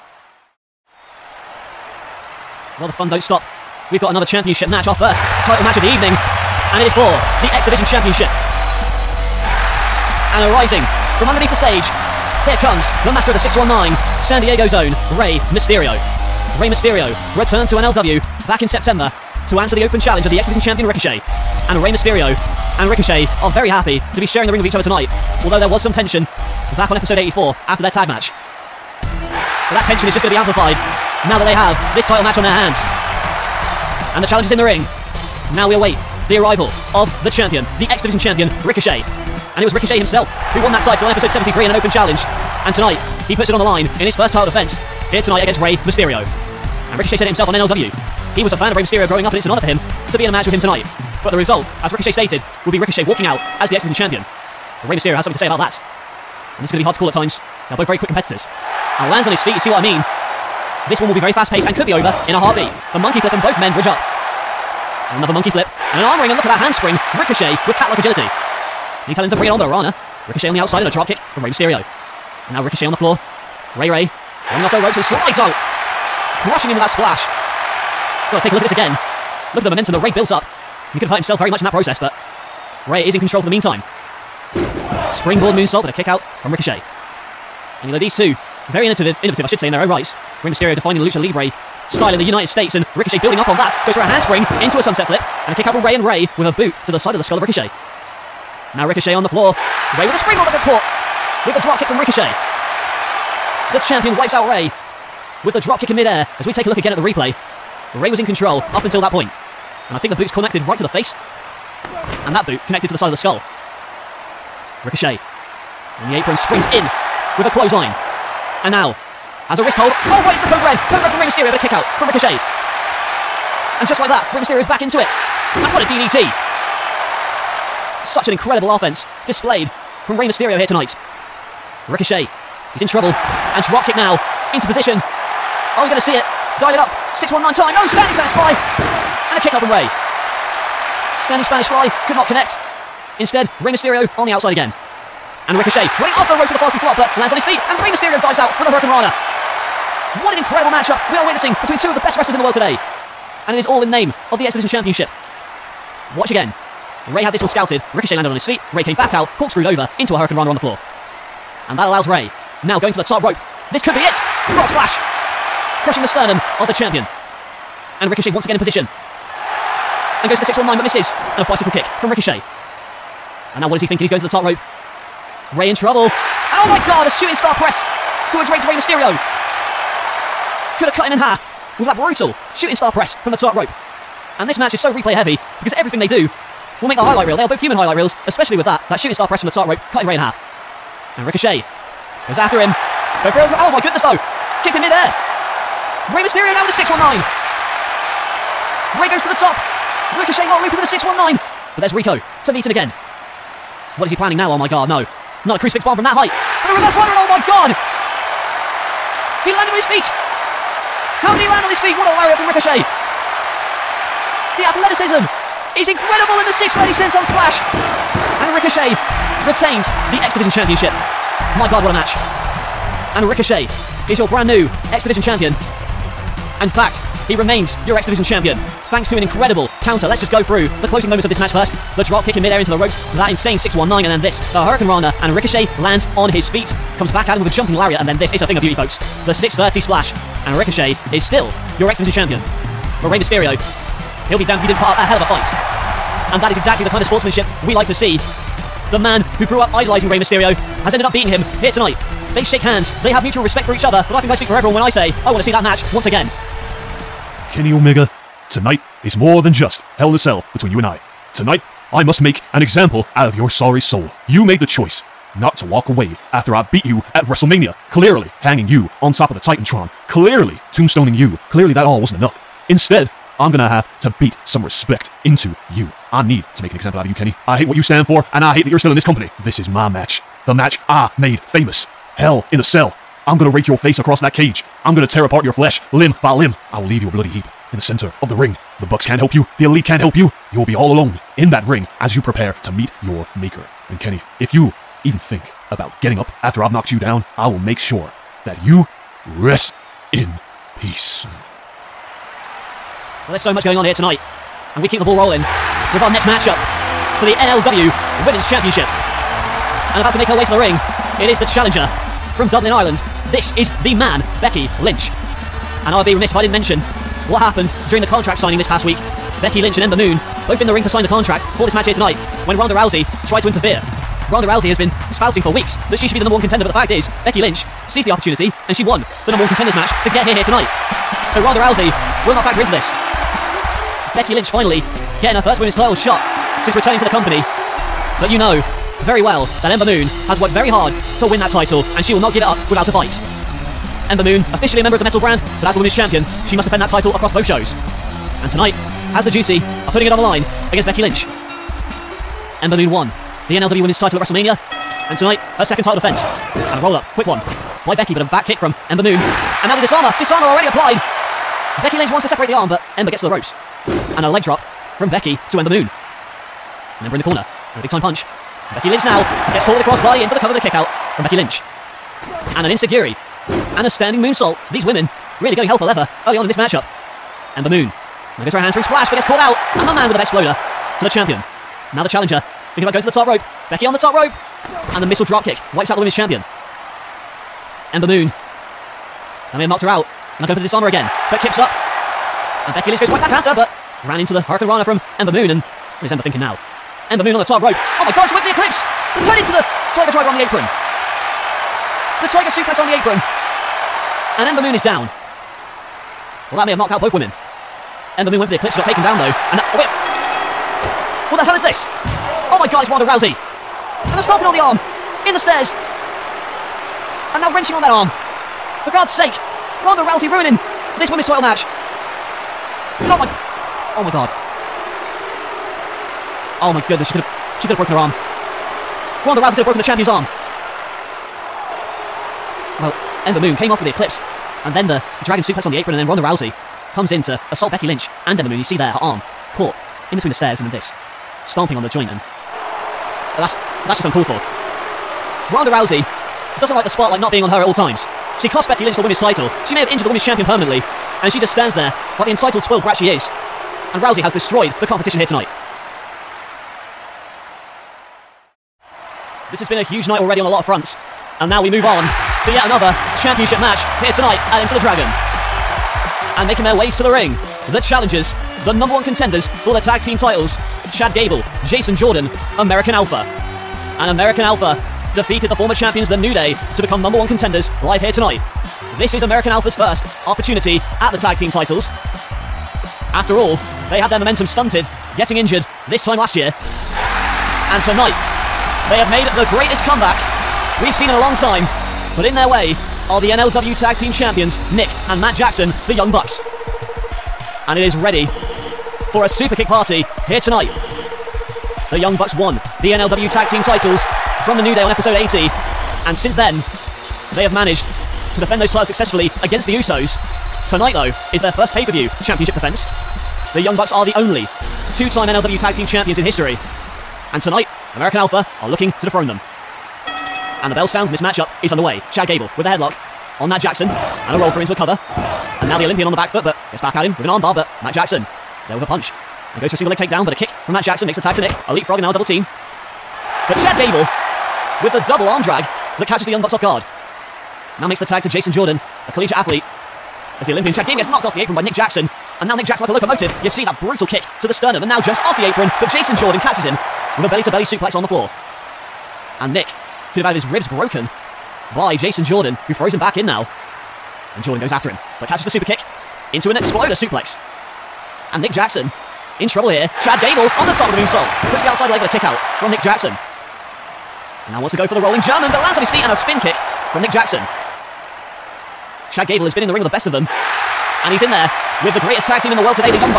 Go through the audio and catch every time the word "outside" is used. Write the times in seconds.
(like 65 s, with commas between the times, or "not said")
70 s, 144 s, 561 s.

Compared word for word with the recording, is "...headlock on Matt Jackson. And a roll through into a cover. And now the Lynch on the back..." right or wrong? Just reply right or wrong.
wrong.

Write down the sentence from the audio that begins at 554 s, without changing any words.
And Jordan goes after him, but catches the super kick into an exploder suplex.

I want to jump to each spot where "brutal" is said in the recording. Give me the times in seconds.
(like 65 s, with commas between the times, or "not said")
181 s, 543 s.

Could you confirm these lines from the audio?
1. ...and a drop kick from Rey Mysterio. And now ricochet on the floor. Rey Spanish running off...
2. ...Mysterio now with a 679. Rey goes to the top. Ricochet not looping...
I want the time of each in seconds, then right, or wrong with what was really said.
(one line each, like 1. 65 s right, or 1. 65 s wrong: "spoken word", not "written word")
1. 70 s wrong: "Rey", not "Spanish"
2. 196 s wrong: "619", not "679".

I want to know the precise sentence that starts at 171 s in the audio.
And a bicycle kick from Ricochet.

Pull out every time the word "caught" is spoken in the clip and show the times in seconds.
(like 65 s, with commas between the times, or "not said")
100 s, 369 s, 379 s, 439 s.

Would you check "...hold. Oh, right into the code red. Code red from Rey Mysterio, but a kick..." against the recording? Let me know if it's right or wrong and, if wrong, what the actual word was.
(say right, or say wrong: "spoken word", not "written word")
right.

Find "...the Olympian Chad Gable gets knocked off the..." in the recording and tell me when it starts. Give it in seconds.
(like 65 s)
540 s.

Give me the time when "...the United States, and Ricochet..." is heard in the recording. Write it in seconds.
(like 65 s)
92 s.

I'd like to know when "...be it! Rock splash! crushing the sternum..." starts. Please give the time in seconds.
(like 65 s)
163 s.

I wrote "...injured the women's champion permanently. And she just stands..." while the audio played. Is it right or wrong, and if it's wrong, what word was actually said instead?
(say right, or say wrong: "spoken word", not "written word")
right.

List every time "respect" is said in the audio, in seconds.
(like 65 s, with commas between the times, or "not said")
253 s, 274 s.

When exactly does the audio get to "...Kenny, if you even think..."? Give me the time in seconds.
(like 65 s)
293 s.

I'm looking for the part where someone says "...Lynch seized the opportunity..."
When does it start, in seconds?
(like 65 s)
327 s.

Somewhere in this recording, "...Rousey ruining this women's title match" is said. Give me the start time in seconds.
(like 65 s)
420 s.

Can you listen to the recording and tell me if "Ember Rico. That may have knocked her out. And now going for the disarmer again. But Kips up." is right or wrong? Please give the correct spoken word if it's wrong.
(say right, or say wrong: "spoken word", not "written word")
wrong: "Moon", not "Rico".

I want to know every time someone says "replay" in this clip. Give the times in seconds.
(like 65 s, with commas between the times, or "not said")
106 s, 184 s.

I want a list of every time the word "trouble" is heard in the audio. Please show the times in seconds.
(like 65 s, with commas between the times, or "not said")
132 s, 175 s, 559 s.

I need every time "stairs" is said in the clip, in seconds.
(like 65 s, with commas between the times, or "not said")
415 s, 440 s.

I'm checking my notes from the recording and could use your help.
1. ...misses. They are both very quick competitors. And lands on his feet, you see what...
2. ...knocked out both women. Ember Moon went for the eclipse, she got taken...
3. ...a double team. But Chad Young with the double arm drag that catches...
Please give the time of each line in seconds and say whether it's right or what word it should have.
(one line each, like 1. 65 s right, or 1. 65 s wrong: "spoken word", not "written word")
1. 57 s wrong: "times", not "misses"
2. 406 s right
3. 532 s wrong: "Gable", not "Young".